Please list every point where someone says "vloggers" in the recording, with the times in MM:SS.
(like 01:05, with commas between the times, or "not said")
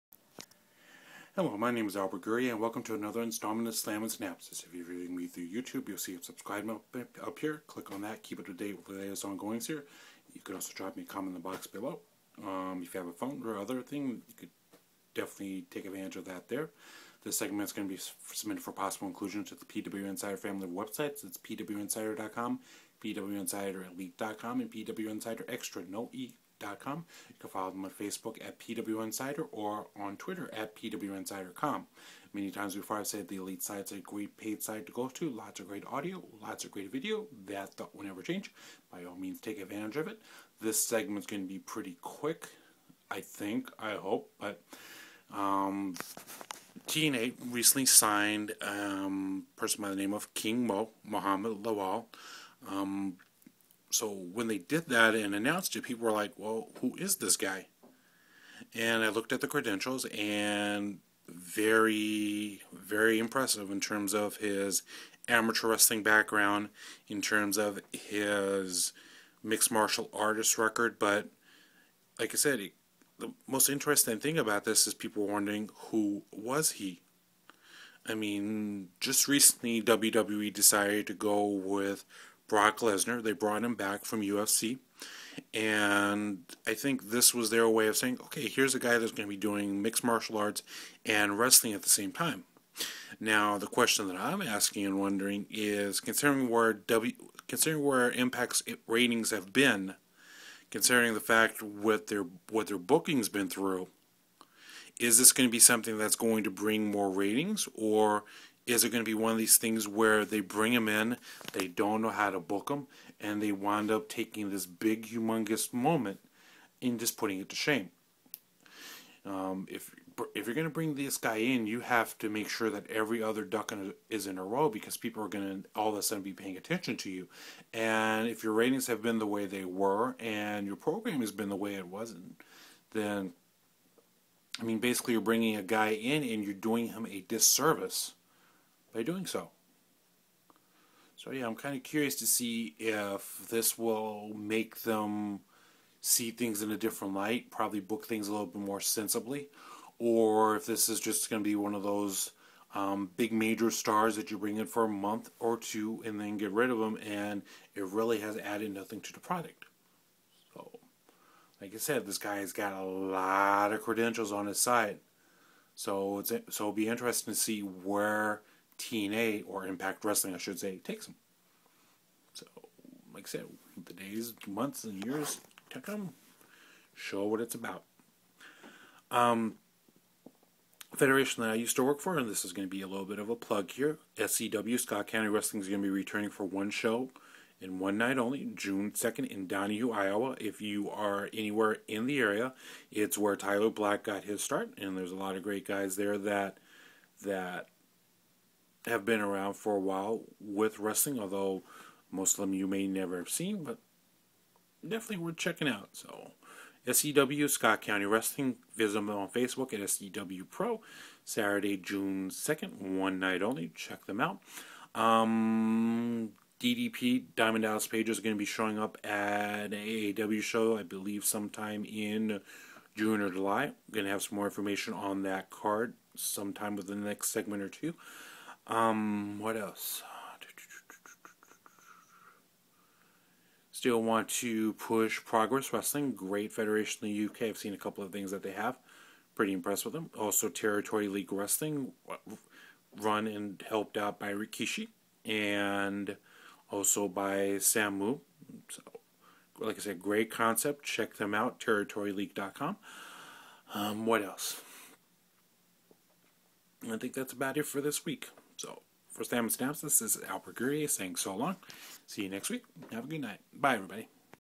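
not said.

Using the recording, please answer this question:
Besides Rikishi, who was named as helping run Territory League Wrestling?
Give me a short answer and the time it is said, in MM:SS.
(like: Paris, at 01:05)
Samu, at 04:07.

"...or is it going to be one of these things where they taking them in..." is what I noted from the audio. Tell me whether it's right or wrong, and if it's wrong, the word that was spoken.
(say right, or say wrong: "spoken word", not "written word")
wrong: "bring", not "taking".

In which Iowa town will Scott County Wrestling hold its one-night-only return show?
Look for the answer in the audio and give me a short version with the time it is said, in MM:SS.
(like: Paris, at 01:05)
Donahue, at 03:09.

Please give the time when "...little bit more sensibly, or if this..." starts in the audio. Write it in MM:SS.
02:28.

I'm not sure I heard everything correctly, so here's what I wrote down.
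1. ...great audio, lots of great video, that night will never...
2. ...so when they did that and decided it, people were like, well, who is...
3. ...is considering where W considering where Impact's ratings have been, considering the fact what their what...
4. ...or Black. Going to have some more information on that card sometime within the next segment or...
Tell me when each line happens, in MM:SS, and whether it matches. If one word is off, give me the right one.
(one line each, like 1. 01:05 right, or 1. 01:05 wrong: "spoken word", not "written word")
1. 00:35 wrong: "thought", not "night"
2. 00:53 wrong: "announced", not "decided"
3. 01:35 right
4. 03:43 wrong: "July", not "Black".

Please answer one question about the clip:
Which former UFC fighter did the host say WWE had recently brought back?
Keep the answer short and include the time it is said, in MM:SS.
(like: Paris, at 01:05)
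Brock Lesnar, at 01:22.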